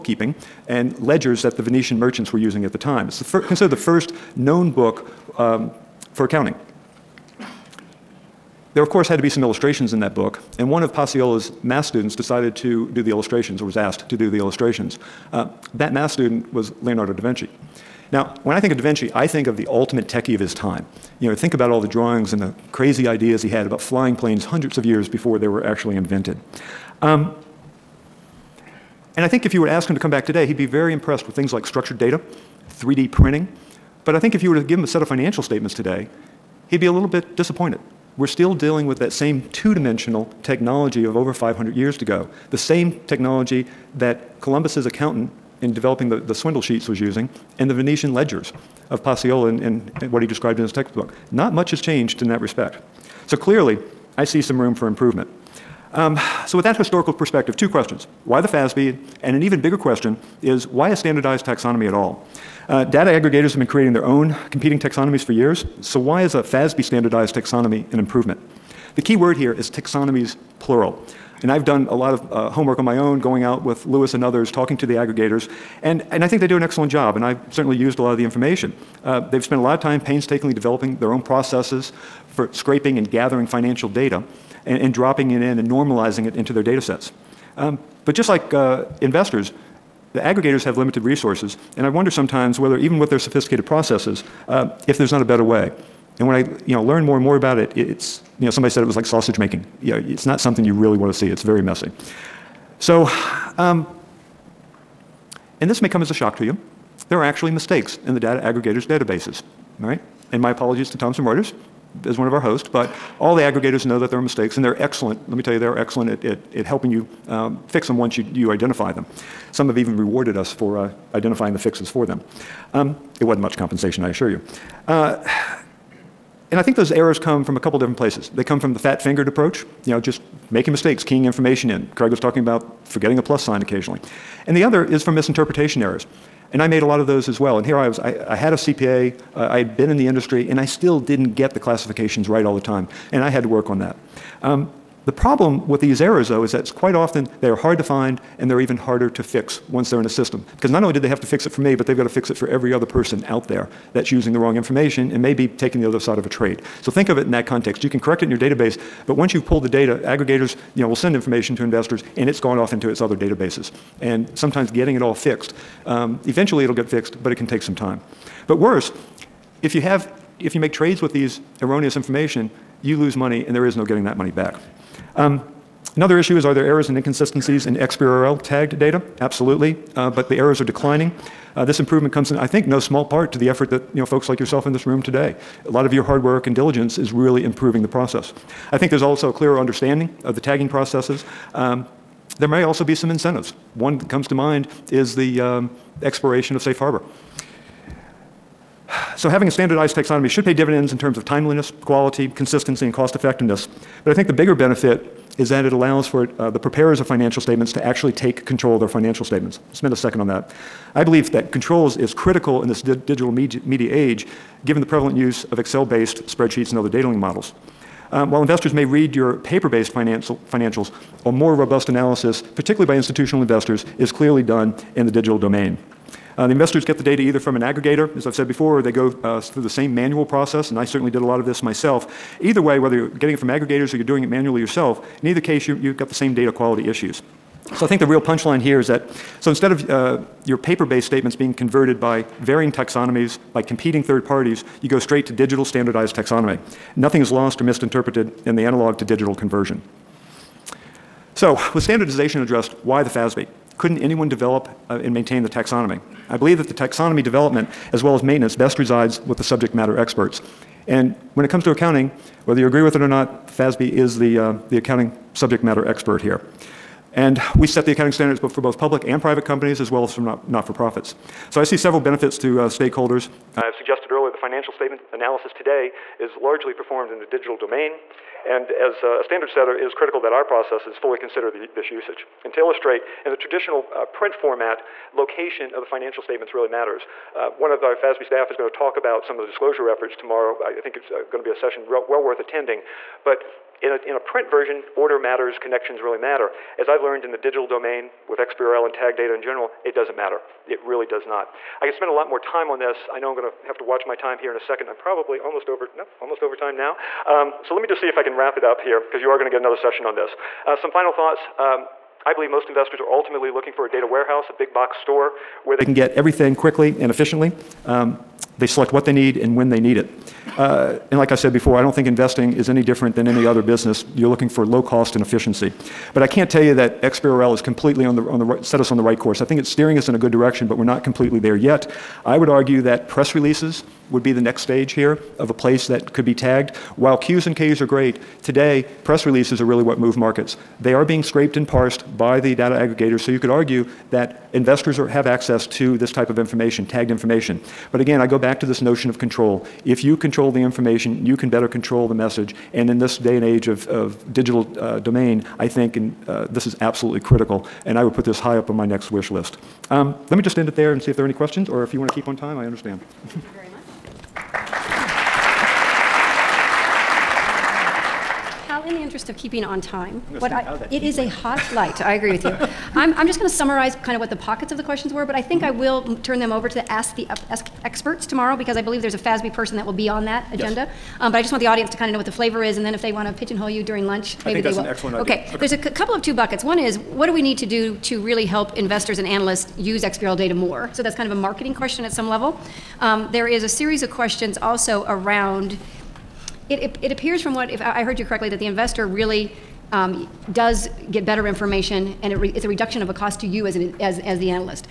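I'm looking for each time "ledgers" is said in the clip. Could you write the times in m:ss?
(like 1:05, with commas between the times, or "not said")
0:00, 0:48.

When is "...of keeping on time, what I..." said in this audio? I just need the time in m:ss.
6:09.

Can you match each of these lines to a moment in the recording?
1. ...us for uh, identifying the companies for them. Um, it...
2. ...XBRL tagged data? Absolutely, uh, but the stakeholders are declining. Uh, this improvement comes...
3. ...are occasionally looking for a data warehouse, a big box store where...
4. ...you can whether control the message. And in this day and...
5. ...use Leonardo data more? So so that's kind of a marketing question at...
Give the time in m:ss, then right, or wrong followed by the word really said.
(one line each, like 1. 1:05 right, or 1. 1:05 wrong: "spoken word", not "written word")
1. 2:00 wrong: "fixes", not "companies"
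2. 2:57 wrong: "errors", not "stakeholders"
3. 5:12 wrong: "ultimately", not "occasionally"
4. 5:51 wrong: "better", not "whether"
5. 6:29 wrong: "XBRL", not "Leonardo".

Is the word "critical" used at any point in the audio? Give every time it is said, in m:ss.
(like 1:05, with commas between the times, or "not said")
3:32, 4:39, 5:57.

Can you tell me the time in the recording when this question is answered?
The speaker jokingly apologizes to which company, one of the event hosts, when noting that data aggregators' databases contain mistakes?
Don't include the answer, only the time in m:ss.
1:50.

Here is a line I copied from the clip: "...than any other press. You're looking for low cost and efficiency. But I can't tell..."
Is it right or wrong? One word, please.
wrong.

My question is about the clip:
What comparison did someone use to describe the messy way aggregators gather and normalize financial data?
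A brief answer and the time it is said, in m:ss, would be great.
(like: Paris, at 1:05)
sausage making, at 1:39.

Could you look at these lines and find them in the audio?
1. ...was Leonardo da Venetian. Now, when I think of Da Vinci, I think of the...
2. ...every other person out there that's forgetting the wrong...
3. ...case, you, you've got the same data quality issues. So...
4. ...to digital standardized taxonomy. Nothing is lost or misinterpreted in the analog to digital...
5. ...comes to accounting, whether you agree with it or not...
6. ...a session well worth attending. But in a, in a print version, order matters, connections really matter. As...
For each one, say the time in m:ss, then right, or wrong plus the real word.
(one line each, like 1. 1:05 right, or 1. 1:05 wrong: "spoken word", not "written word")
1. 0:16 wrong: "Vinci", not "Venetian"
2. 2:32 wrong: "using", not "forgetting"
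3. 3:55 right
4. 4:05 right
5. 4:21 right
6. 4:51 right.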